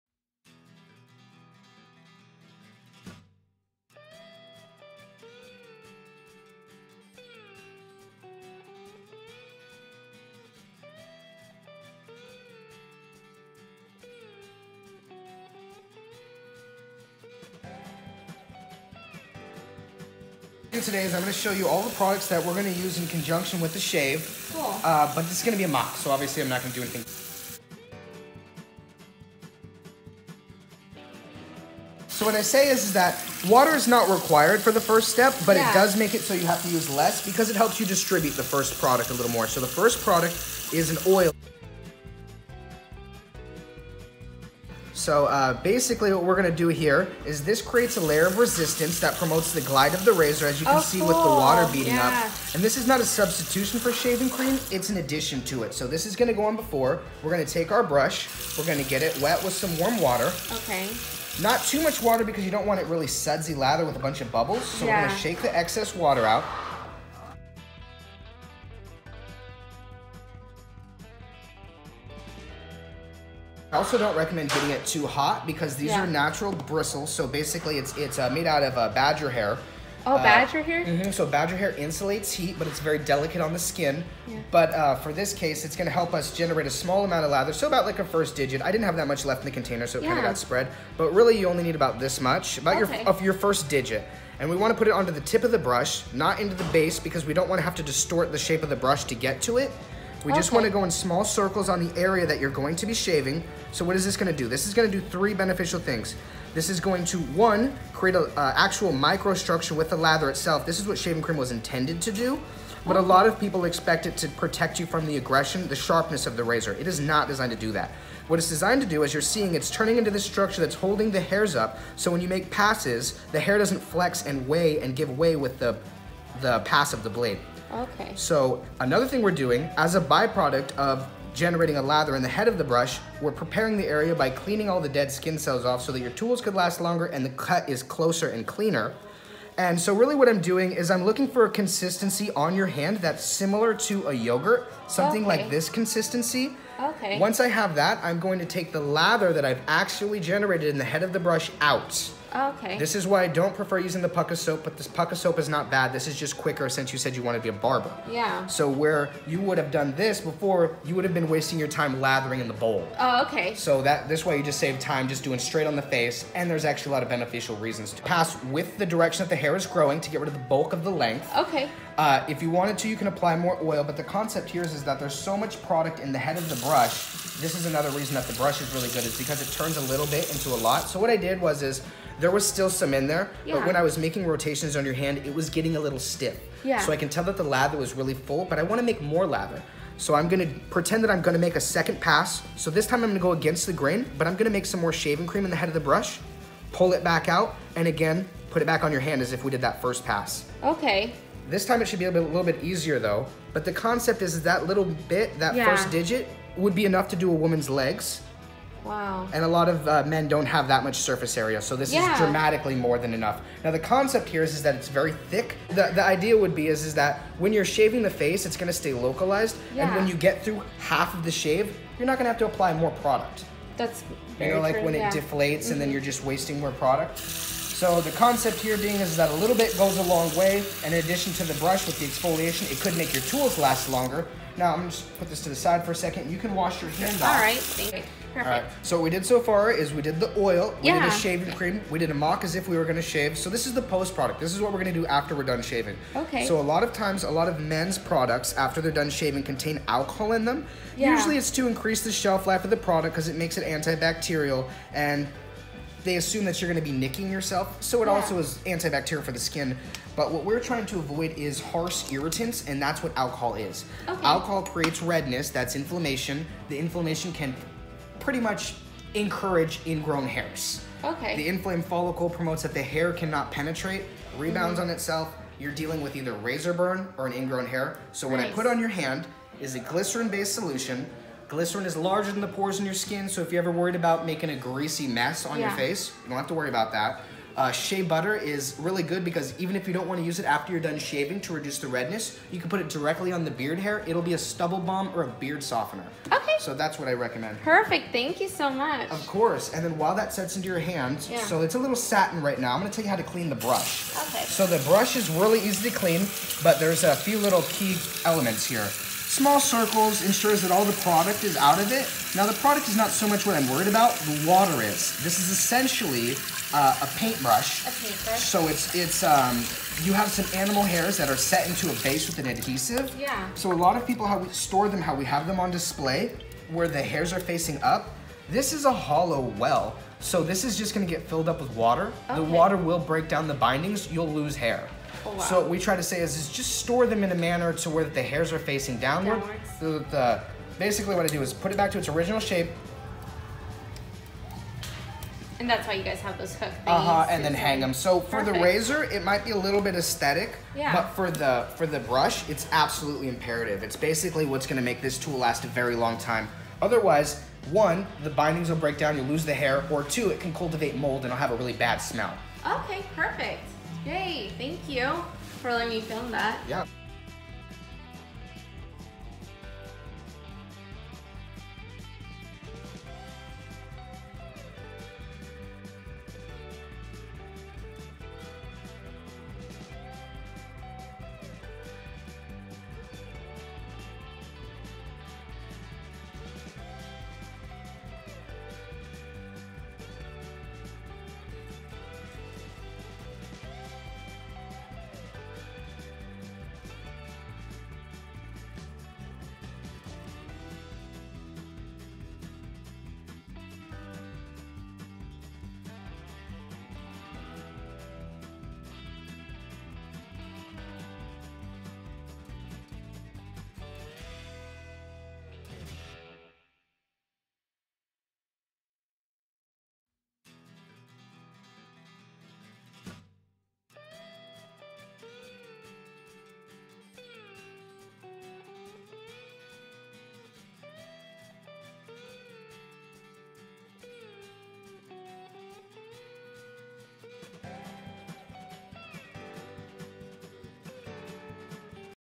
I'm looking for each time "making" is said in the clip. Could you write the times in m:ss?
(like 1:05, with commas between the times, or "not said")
3:03, 4:44.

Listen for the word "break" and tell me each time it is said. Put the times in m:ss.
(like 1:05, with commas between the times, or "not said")
5:32, 5:58.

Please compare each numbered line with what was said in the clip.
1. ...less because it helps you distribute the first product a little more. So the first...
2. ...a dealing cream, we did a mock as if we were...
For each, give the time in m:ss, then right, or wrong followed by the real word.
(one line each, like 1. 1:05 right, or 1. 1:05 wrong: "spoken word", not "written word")
1. 0:36 right
2. 4:01 wrong: "shaving", not "dealing".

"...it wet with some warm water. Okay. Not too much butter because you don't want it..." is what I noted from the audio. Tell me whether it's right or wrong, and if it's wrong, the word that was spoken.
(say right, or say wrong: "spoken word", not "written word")
wrong: "water", not "butter".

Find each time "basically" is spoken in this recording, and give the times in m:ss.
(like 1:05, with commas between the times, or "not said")
0:45, 1:17, 5:40, 5:53.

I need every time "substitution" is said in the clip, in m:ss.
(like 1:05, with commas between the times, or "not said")
0:53.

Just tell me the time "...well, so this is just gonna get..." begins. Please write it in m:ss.
5:29.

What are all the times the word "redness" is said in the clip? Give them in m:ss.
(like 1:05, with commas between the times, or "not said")
4:25, 4:51.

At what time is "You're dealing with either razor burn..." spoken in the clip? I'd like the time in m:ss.
4:35.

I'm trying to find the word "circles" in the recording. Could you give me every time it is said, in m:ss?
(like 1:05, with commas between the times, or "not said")
1:41, 5:09.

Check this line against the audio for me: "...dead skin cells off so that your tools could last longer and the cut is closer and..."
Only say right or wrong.
right.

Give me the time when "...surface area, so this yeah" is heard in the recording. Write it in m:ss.
3:30.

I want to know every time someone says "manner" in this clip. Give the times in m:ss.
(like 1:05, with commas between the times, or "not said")
5:37.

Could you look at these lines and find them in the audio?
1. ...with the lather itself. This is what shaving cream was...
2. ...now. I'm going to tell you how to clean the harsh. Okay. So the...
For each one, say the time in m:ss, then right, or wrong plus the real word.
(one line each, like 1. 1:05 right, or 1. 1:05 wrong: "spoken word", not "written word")
1. 1:49 right
2. 5:02 wrong: "brush", not "harsh".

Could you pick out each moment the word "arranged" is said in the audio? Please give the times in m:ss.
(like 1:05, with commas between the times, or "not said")
not said.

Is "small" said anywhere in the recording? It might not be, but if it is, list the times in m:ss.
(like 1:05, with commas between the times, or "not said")
1:26, 1:40, 5:09.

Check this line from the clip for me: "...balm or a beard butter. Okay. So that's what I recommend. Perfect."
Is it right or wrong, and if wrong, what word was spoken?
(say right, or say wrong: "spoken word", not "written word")
wrong: "softener", not "butter".